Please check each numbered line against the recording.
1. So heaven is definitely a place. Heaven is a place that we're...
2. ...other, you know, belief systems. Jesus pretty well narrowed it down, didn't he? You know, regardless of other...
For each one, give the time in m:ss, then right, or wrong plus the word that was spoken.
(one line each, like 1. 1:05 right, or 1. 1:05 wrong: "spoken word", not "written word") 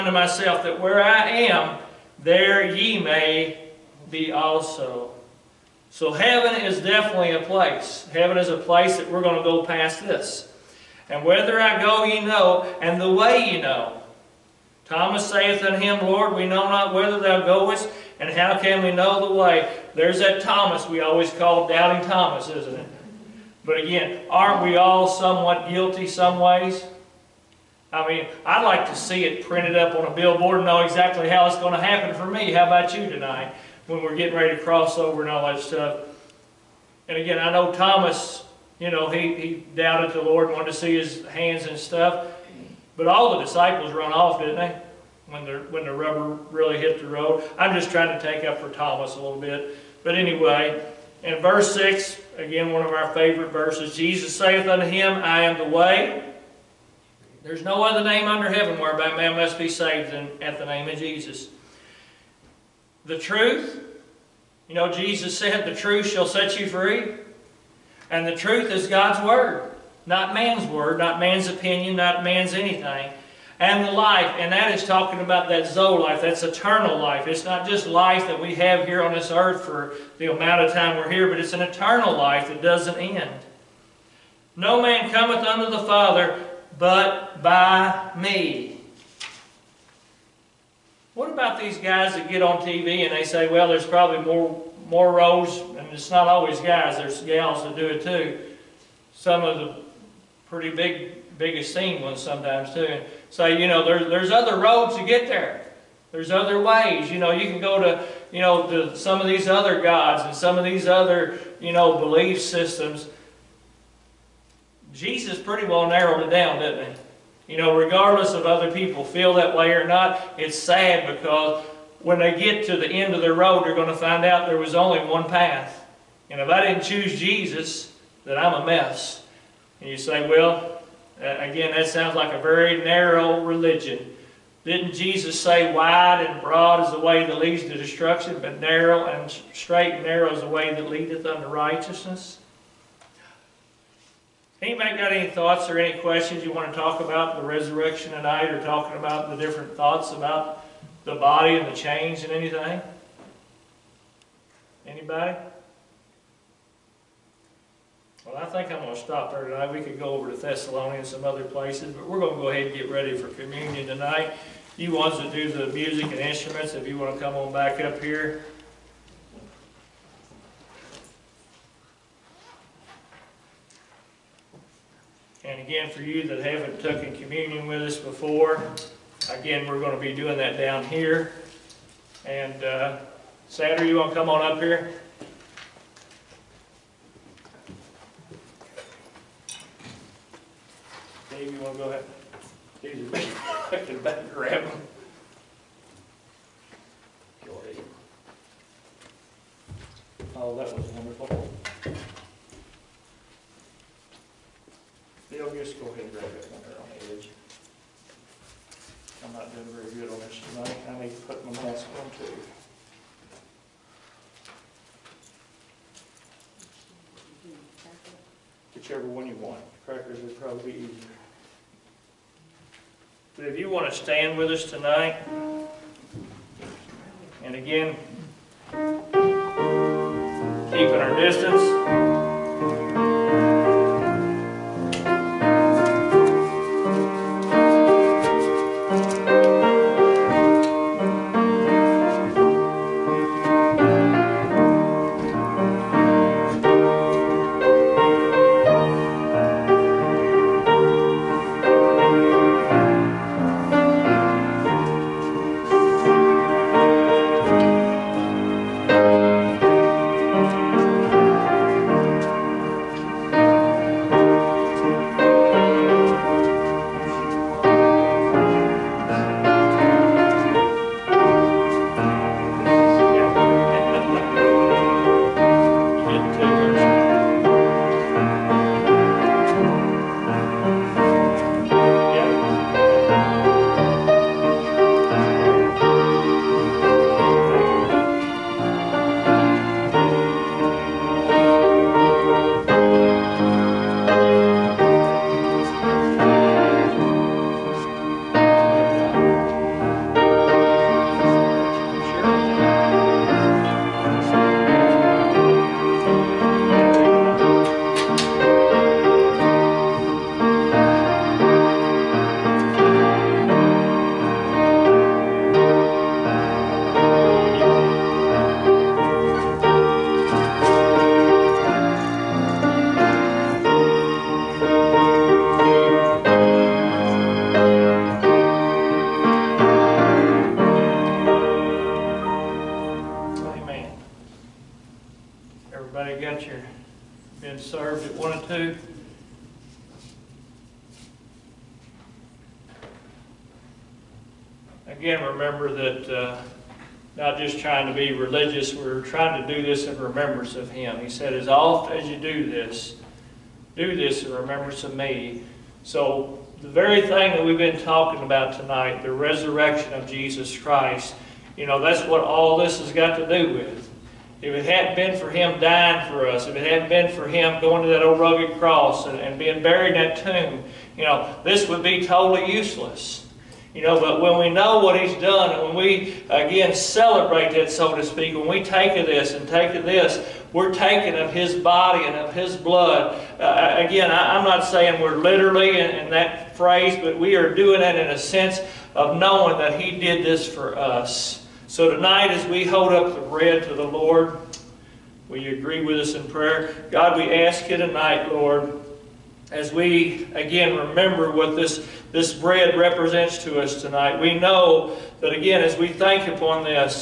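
1. 0:05 right
2. 1:50 right.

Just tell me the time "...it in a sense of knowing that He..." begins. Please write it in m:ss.
6:27.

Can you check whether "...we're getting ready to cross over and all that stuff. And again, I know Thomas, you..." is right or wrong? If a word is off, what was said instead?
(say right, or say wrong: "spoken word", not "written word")
right.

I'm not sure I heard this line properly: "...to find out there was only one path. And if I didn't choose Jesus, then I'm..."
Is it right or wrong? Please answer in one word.
right.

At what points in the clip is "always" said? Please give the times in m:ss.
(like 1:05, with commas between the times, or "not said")
0:21, 1:36.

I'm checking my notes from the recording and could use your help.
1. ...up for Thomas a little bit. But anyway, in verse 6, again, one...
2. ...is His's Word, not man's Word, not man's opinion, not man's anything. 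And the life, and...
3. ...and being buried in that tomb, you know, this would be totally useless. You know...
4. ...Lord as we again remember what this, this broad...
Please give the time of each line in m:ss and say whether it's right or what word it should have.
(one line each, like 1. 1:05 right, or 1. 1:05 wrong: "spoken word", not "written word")
1. 0:48 right
2. 1:08 wrong: "God", not "His"
3. 6:09 right
4. 6:38 wrong: "bread", not "broad".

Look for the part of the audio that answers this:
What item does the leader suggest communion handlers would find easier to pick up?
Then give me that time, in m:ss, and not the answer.
3:39.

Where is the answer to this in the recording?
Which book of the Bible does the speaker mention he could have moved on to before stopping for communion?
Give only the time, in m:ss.
2:40.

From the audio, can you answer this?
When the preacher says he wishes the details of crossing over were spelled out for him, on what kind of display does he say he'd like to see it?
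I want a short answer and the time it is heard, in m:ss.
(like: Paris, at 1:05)
Billboard, at 0:30.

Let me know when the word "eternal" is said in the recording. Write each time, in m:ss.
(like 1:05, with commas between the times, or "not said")
1:16, 1:21.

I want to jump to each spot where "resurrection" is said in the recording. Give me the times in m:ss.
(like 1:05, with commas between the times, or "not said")
2:27, 5:59.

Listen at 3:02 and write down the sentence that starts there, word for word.
And uh, Saturday, you want to come on up here?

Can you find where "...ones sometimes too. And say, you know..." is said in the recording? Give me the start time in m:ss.
1:42.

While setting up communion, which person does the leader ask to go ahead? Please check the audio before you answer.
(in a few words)
Dave.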